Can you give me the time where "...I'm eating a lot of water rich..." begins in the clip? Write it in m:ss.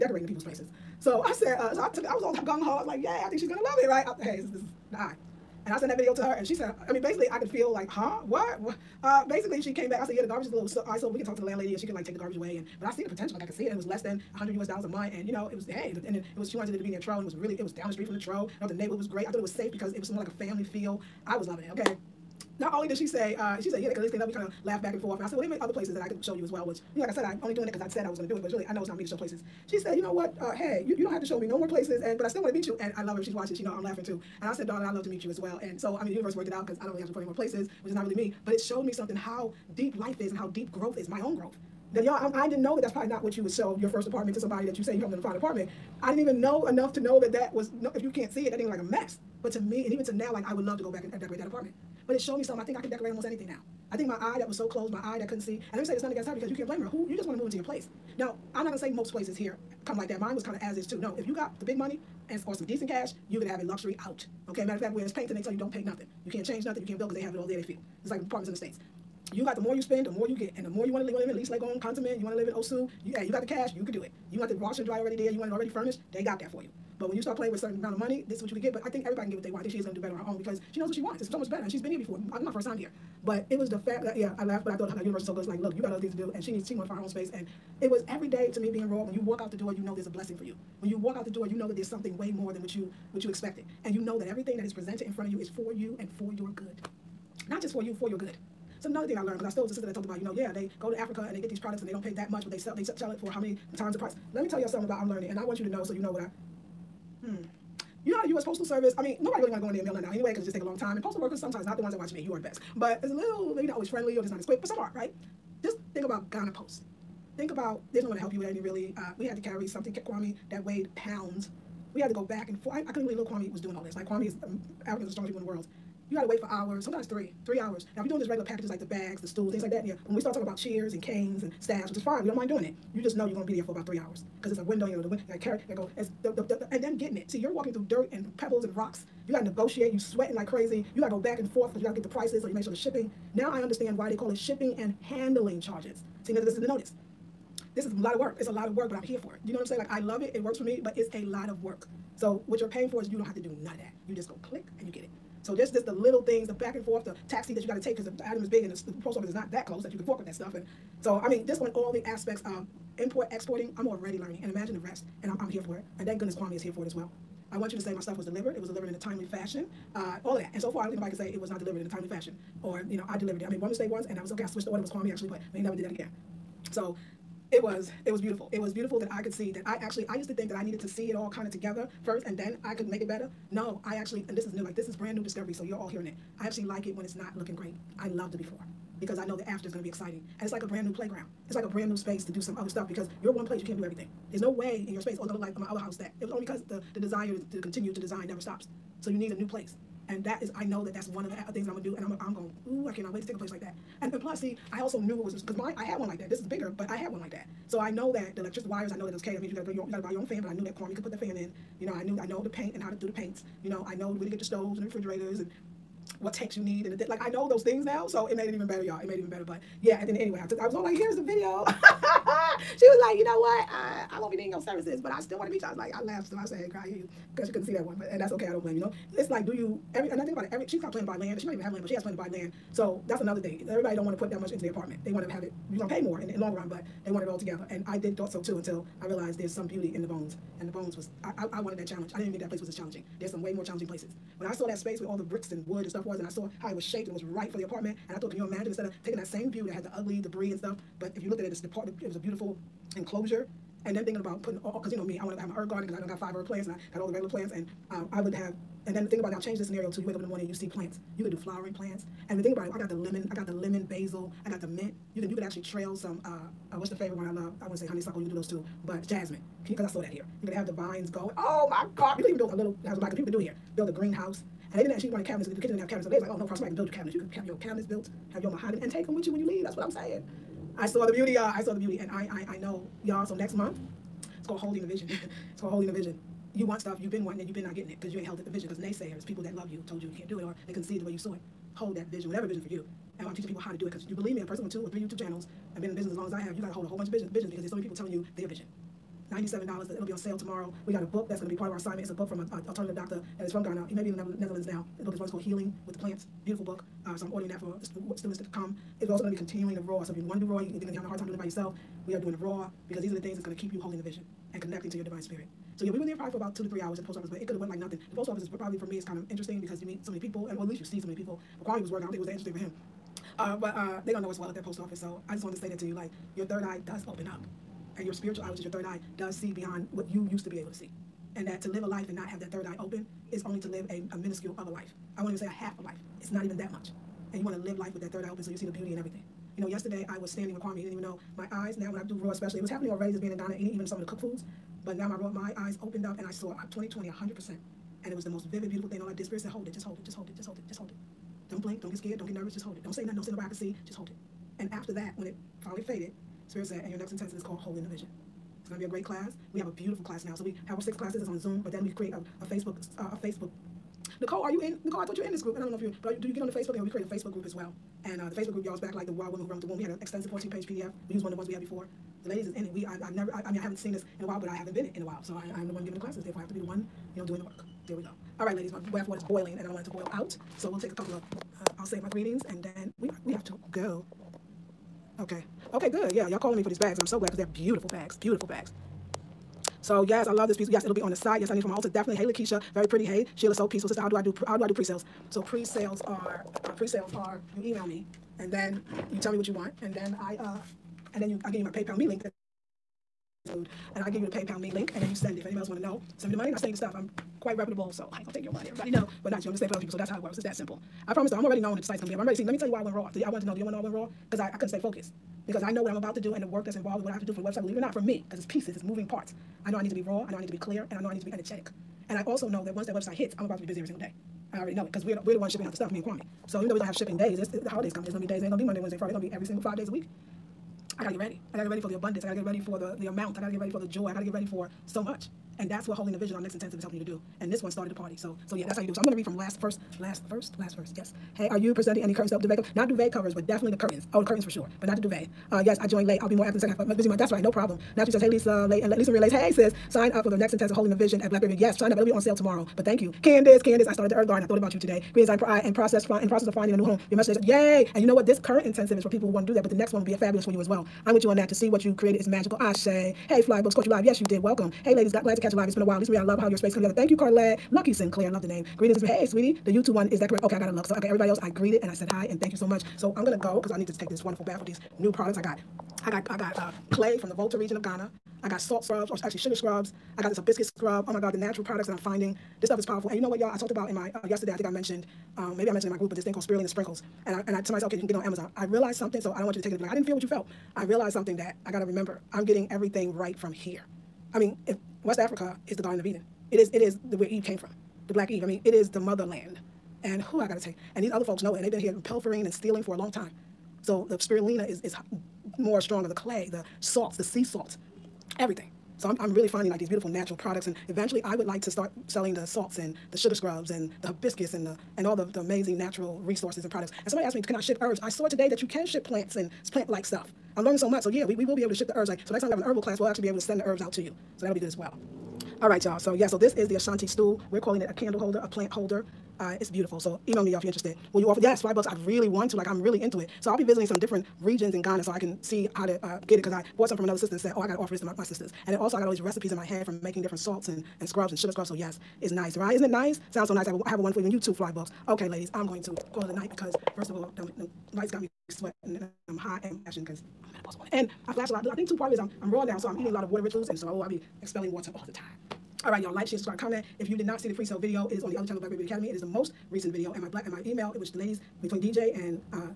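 9:12.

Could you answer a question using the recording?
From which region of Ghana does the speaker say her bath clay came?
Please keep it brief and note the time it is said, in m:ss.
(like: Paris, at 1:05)
Volta region, at 7:57.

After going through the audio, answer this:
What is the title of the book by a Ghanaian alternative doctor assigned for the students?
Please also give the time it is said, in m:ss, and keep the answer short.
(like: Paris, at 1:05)
Healing with the Plants, at 5:05.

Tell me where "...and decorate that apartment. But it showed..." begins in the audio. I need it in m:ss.
0:51.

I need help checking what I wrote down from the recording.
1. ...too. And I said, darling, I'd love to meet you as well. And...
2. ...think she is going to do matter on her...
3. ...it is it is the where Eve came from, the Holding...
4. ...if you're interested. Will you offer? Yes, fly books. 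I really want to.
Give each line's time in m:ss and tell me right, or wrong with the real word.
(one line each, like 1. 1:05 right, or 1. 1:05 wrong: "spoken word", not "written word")
1. 0:34 right
2. 1:19 wrong: "better", not "matter"
3. 8:16 wrong: "Black", not "Holding"
4. 8:50 right.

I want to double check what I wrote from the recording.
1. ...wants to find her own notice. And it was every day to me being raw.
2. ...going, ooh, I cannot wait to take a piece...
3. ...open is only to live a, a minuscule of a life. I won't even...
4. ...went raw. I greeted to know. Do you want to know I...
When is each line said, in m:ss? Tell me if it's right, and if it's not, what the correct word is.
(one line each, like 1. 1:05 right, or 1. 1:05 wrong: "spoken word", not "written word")
1. 1:26 wrong: "space", not "notice"
2. 3:22 wrong: "place", not "piece"
3. 5:32 right
4. 6:52 wrong: "wanted", not "greeted".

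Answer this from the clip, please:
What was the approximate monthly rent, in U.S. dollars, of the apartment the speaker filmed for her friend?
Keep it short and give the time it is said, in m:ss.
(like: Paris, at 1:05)
less than 100, at 0:13.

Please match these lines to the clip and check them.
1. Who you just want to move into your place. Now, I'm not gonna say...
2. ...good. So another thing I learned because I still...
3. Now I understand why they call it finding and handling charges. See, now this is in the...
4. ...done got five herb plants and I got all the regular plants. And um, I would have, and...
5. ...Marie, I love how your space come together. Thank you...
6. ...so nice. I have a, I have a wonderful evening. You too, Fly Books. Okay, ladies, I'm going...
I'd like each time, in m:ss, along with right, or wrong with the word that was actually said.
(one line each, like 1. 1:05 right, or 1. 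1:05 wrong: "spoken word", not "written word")
1. 0:56 right
2. 1:38 right
3. 2:23 wrong: "shipping", not "finding"
4. 4:15 right
5. 7:46 right
6. 9:03 right.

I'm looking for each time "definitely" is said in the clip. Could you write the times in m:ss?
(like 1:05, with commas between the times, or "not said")
6:31, 7:23.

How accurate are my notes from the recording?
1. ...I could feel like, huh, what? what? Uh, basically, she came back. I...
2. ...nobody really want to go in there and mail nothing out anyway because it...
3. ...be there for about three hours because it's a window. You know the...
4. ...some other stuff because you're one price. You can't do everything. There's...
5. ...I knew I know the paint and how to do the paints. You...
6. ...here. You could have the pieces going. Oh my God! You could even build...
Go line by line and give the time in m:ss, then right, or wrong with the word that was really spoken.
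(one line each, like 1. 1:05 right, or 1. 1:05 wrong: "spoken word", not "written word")
1. 0:07 right
2. 1:49 right
3. 2:13 right
4. 3:12 wrong: "place", not "price"
5. 3:31 right
6. 4:30 wrong: "vines", not "pieces".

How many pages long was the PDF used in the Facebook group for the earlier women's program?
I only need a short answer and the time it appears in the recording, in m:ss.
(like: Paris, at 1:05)
14, at 6:10.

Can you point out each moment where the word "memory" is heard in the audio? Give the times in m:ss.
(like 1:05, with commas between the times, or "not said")
not said.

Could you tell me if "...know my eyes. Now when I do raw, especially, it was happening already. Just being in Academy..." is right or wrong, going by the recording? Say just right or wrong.
wrong.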